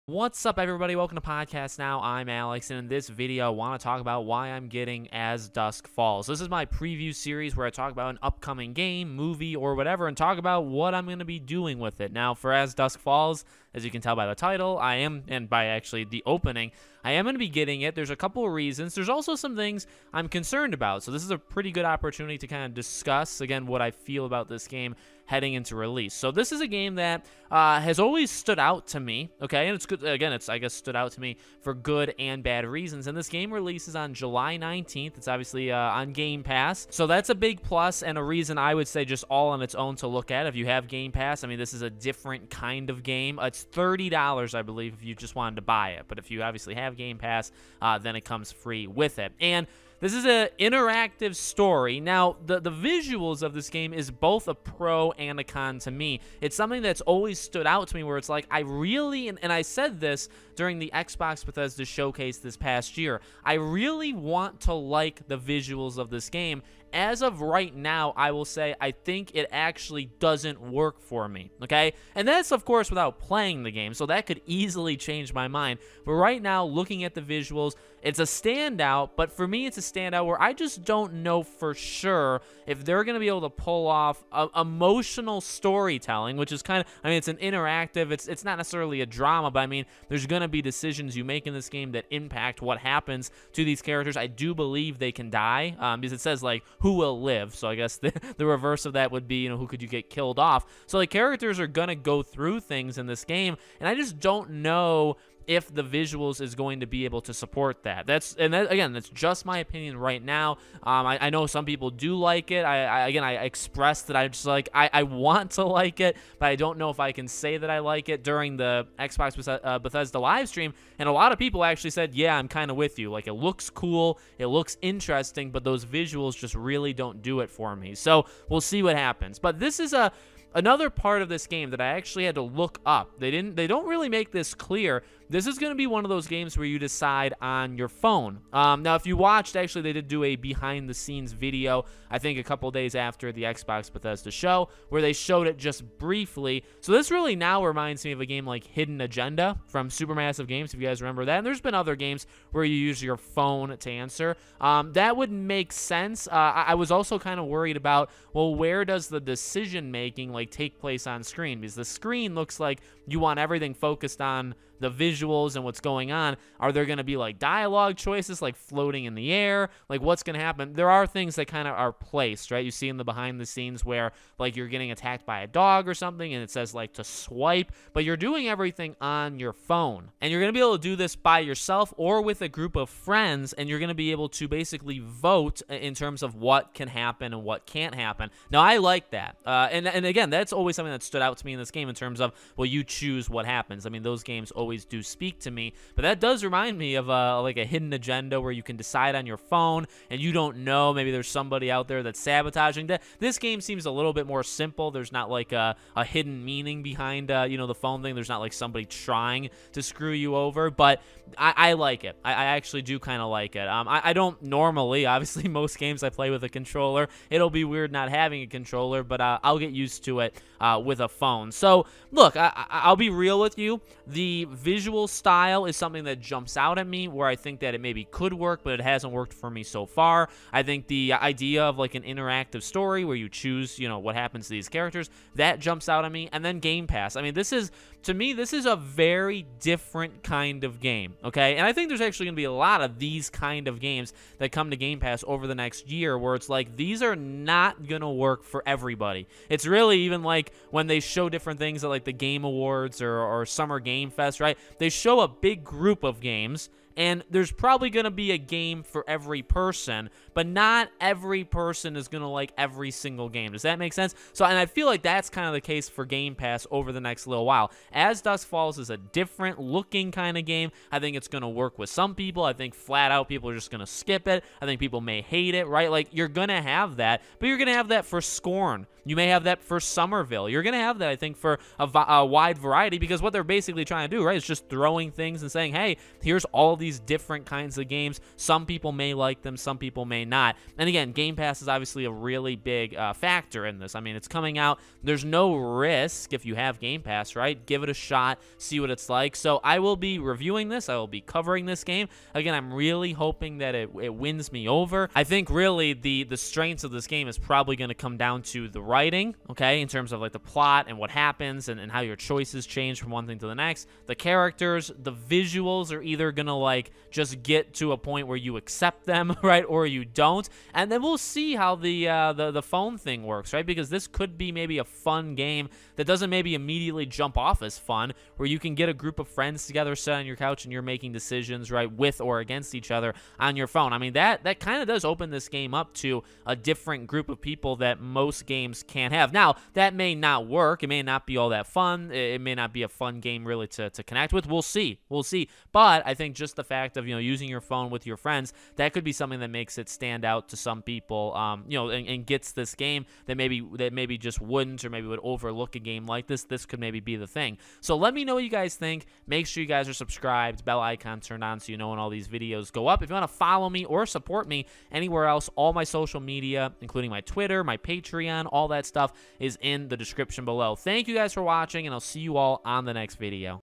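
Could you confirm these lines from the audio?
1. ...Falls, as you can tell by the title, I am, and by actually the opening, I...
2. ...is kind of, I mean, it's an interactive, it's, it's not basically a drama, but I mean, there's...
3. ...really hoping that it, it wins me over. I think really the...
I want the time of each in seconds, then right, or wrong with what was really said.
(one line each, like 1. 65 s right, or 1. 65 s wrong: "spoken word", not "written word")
1. 12 s right
2. 86 s wrong: "necessarily", not "basically"
3. 302 s right.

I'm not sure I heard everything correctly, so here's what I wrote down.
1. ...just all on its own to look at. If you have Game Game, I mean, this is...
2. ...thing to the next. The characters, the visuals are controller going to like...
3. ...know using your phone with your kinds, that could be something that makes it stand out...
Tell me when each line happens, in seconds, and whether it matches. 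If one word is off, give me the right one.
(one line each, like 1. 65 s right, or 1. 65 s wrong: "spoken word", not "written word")
1. 39 s wrong: "Pass", not "Game"
2. 313 s wrong: "either", not "controller"
3. 347 s wrong: "friends", not "kinds".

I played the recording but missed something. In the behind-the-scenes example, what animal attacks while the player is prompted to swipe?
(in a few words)
A dog.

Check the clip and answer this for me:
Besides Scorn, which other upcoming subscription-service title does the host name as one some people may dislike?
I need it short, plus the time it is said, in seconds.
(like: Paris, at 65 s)
Somerville, at 279 s.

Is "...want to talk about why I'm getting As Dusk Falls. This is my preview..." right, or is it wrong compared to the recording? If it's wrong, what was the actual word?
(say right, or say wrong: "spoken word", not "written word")
right.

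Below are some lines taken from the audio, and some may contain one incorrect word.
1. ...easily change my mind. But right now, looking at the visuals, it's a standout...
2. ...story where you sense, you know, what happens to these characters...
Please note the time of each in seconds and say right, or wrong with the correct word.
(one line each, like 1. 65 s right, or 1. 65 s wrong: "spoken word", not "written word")
1. 74 s right
2. 232 s wrong: "choose", not "sense".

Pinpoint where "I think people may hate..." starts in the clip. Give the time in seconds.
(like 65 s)
274 s.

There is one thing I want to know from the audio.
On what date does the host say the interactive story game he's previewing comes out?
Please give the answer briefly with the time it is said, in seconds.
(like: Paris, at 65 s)
July 19th, at 34 s.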